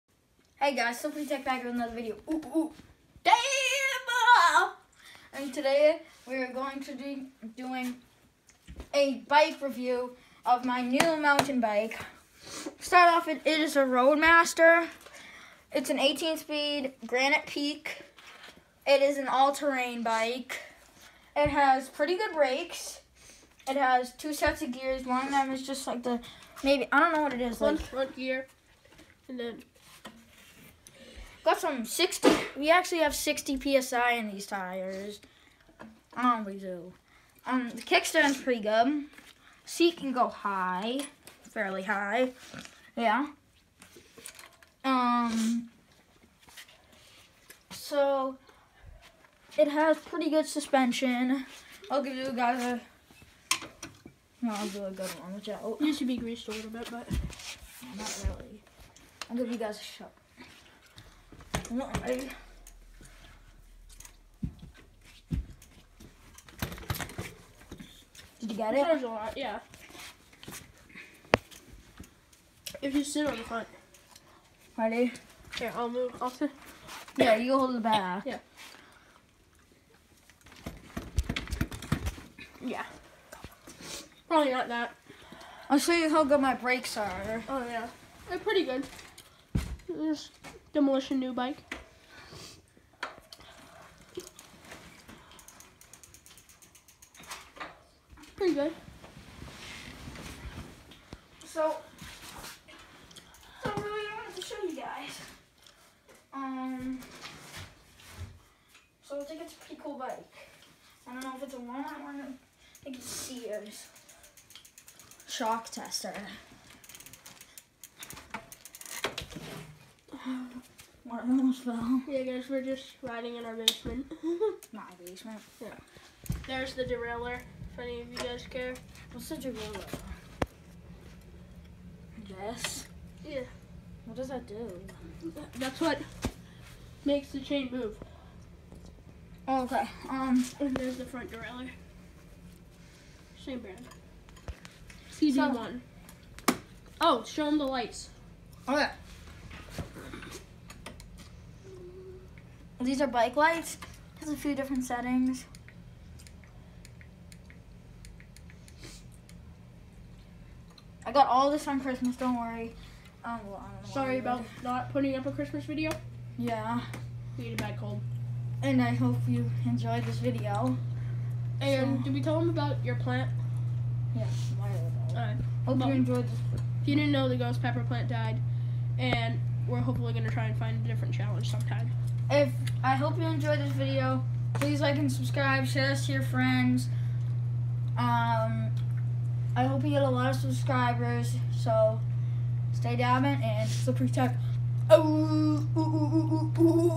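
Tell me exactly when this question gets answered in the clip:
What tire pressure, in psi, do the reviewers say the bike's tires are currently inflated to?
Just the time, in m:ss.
0:33.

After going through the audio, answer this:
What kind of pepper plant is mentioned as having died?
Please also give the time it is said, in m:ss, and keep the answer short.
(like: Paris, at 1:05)
Ghost pepper, at 2:57.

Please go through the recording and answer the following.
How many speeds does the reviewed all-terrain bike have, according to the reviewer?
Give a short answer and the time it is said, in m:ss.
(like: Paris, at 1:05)
18, at 0:15.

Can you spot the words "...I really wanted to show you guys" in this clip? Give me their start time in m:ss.
1:43.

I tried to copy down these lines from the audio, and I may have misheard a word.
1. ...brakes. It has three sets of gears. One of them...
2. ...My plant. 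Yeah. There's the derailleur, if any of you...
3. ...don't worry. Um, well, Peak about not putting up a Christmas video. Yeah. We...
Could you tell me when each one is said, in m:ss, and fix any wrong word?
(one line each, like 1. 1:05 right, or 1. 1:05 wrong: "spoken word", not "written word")
1. 0:22 wrong: "two", not "three"
2. 2:04 wrong: "basement", not "plant"
3. 2:42 wrong: "Sorry", not "Peak".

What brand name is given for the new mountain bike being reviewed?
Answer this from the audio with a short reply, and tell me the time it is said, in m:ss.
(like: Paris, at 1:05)
Roadmaster, at 0:13.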